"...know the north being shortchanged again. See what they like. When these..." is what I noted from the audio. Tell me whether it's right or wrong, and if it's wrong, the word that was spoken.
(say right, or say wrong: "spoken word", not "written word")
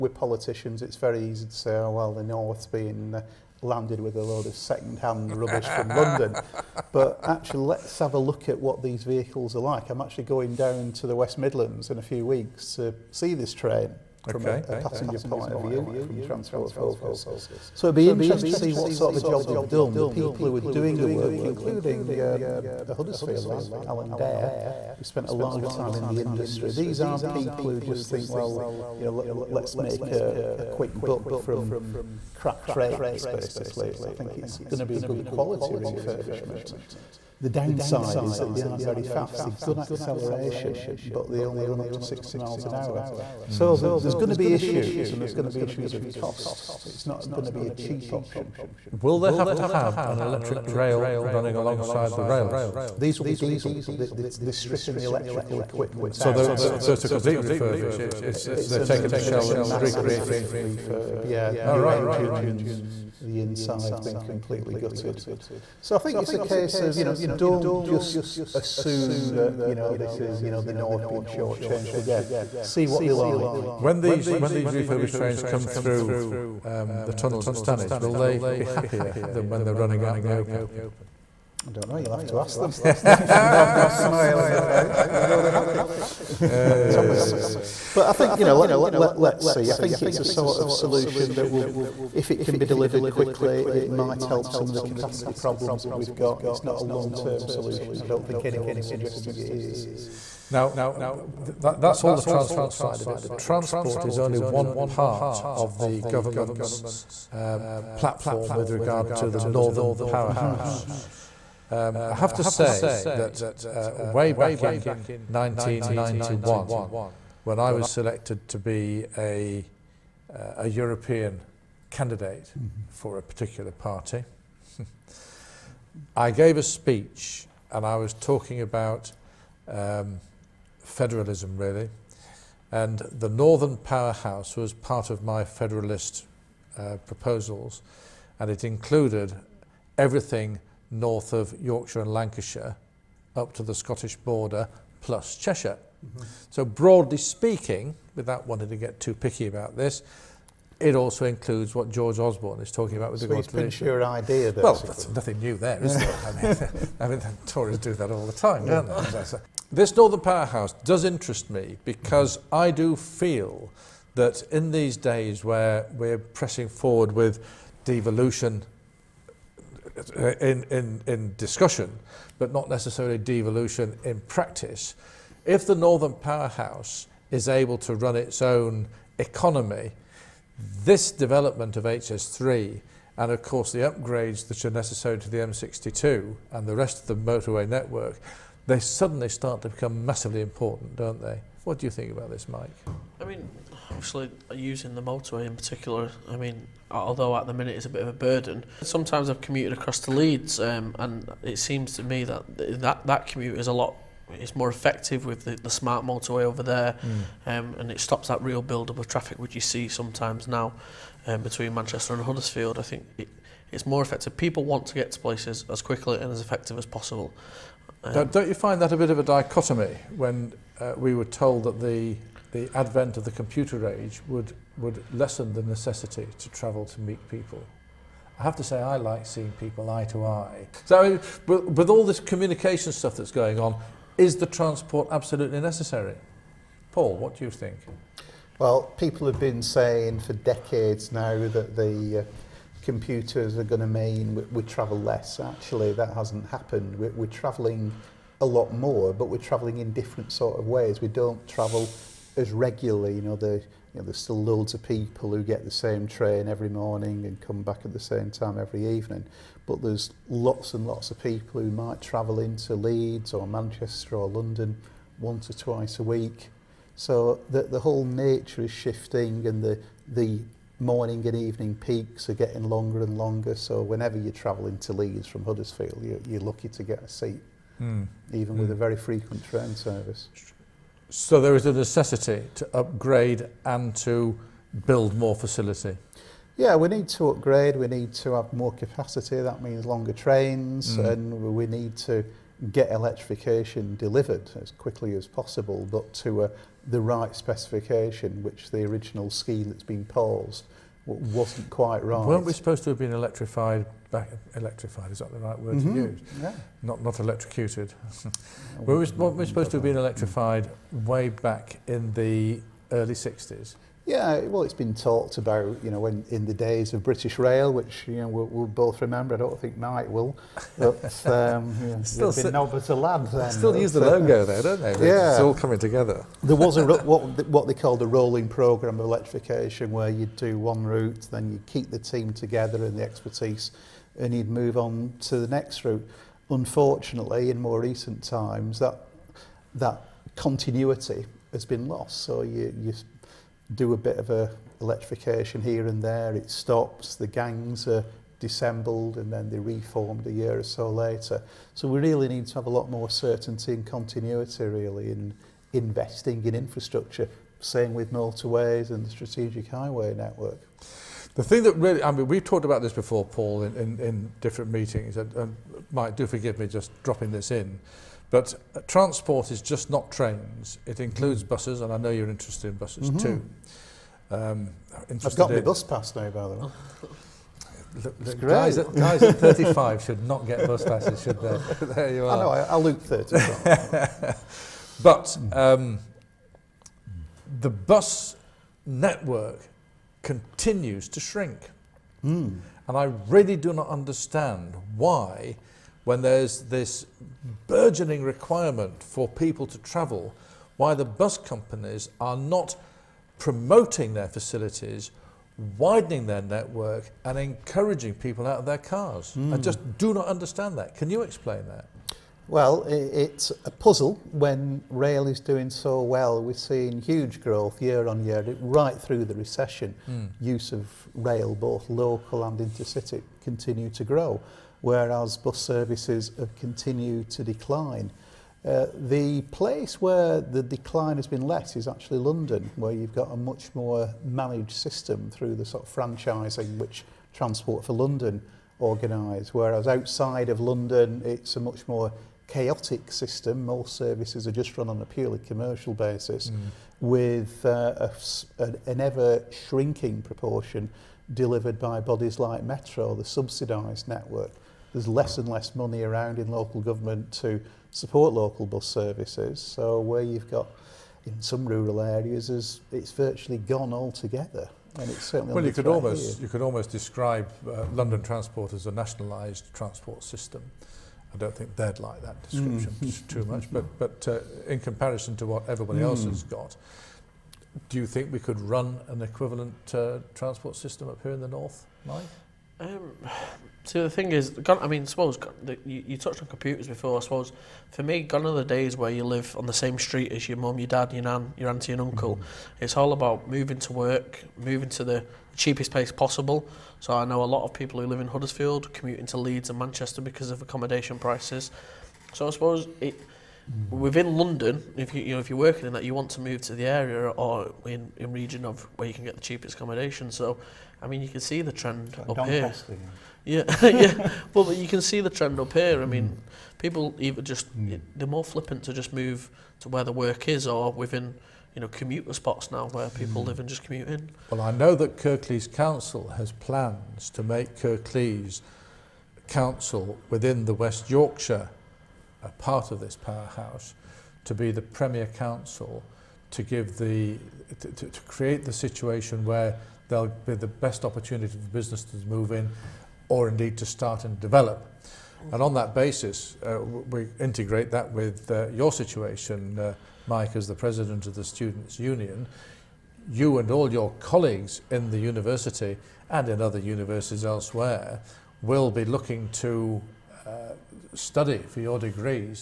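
right.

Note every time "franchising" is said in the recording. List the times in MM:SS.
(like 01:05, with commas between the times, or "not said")
07:15.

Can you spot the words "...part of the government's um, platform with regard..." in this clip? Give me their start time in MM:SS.
01:44.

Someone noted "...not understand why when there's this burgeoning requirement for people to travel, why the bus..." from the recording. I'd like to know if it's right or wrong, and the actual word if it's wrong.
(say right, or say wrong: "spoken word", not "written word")
right.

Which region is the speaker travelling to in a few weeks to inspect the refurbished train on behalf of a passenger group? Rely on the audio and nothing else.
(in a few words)
West Midlands.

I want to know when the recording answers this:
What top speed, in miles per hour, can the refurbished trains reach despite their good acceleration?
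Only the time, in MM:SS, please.
00:42.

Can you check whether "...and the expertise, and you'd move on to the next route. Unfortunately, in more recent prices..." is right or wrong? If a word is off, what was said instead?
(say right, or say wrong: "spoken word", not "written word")
wrong: "times", not "prices".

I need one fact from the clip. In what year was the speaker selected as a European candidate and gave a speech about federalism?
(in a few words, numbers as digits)
1991.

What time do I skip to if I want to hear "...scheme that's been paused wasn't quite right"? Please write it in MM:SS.
04:59.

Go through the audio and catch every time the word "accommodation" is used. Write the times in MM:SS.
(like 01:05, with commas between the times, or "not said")
08:20, 08:29.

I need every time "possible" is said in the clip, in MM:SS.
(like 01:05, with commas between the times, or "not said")
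03:36, 04:55, 08:16.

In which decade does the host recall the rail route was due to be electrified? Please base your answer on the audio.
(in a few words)
the early 60s.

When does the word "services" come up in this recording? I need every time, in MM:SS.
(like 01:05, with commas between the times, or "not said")
04:39, 07:05, 07:23, 07:38.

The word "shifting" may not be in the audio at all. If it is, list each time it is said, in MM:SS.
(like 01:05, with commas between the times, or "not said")
04:28.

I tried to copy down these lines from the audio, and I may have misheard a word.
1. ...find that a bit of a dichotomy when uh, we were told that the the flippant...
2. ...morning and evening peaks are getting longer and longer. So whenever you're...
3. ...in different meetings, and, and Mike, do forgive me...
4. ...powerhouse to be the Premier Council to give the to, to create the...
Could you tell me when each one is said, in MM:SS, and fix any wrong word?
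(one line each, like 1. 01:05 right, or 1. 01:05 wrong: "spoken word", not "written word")
1. 03:38 wrong: "advent", not "flippant"
2. 04:30 right
3. 06:03 right
4. 08:53 right.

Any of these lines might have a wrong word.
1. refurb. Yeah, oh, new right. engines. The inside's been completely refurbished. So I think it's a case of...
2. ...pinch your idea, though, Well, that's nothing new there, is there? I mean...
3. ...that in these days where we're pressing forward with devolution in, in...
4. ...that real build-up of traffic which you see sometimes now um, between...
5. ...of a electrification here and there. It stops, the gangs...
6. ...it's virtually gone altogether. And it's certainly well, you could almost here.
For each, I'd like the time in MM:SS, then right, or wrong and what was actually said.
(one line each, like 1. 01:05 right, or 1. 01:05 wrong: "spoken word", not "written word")
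1. 01:00 wrong: "gutted", not "refurbished"
2. 02:33 right
3. 02:44 right
4. 03:28 right
5. 05:44 right
6. 07:42 right.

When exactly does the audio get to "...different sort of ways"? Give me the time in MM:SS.
04:09.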